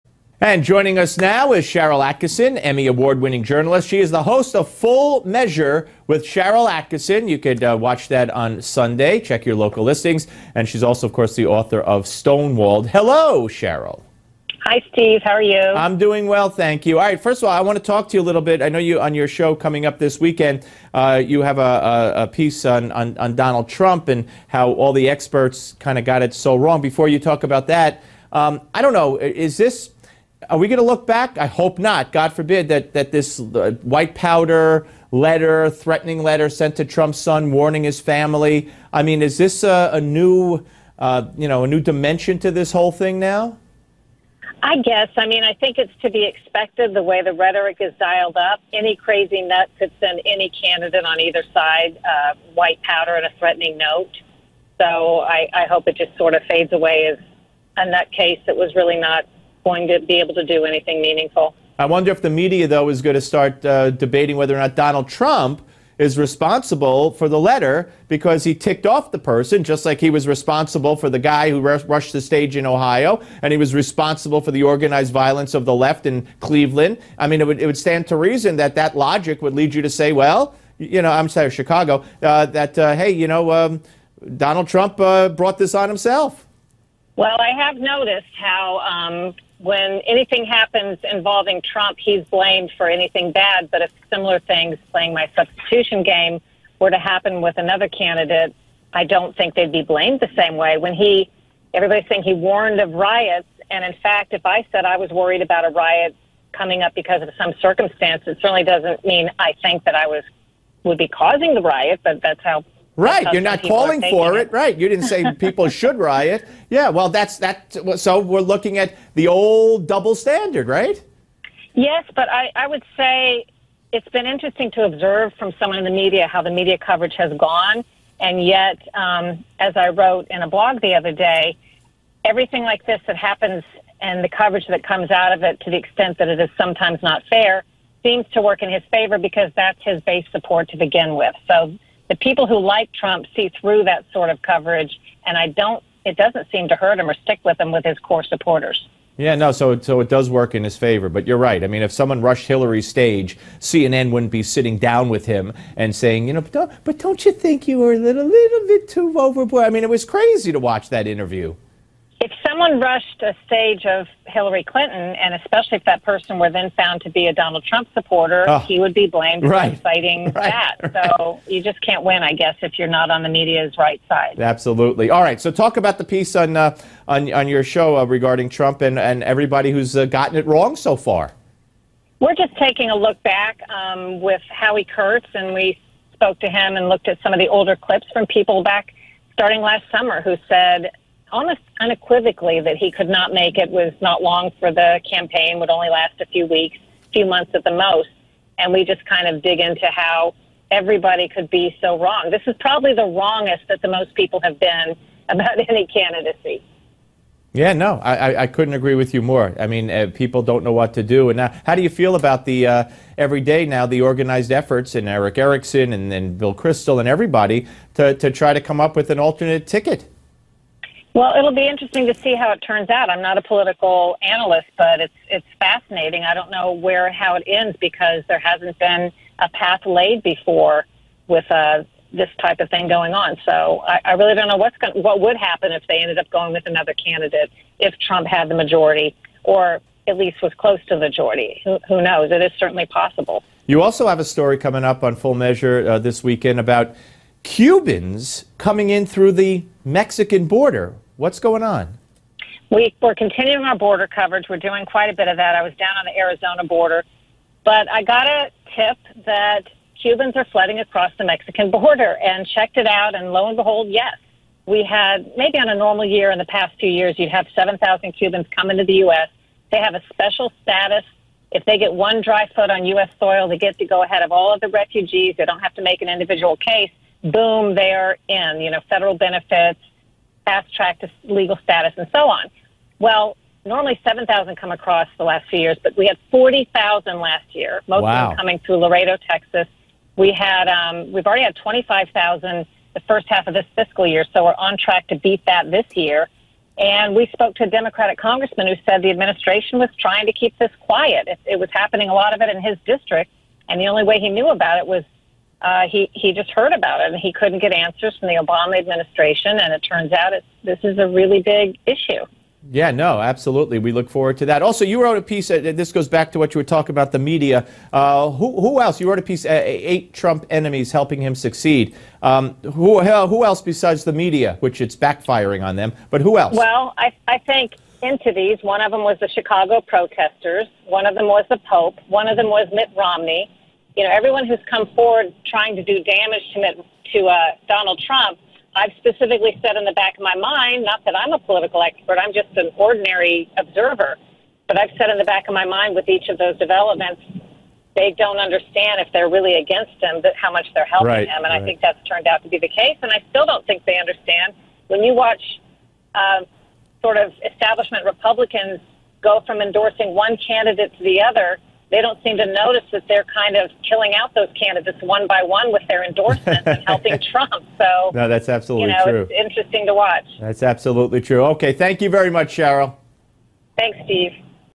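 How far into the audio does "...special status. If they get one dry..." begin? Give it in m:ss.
4:30.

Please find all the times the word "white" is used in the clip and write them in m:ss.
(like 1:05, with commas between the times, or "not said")
0:33, 0:52.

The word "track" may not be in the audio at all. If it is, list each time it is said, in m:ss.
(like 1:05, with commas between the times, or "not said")
4:40, 4:54.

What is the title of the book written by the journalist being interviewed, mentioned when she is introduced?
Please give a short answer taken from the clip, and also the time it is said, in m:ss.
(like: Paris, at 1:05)
Stonewalled, at 0:12.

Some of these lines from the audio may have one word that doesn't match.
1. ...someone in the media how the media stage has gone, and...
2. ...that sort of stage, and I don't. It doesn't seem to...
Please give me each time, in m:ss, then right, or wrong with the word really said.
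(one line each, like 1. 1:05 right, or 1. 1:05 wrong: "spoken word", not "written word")
1. 2:05 wrong: "coverage", not "stage"
2. 2:23 wrong: "coverage", not "stage".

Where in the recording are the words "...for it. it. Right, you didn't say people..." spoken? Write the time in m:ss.
1:54.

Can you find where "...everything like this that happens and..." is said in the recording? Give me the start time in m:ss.
2:12.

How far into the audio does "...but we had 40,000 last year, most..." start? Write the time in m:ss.
4:45.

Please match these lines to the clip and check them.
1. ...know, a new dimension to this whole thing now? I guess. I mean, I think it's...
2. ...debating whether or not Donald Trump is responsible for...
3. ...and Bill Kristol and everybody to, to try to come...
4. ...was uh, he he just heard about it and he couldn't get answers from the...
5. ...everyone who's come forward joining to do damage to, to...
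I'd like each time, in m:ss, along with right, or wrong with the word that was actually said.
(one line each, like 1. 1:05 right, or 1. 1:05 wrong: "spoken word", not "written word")
1. 0:41 right
2. 1:03 right
3. 3:36 right
4. 5:04 right
5. 5:34 wrong: "trying", not "joining".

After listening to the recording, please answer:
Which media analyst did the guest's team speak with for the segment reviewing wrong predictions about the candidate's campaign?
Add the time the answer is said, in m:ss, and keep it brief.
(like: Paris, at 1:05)
Howie Kurtz, at 3:04.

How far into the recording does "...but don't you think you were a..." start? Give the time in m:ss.
2:36.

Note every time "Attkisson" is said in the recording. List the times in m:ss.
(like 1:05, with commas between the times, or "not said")
0:02, 0:06.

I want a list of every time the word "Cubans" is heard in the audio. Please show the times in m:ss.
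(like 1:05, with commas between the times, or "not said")
4:07, 4:20, 4:28.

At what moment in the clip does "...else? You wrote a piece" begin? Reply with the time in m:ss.
5:18.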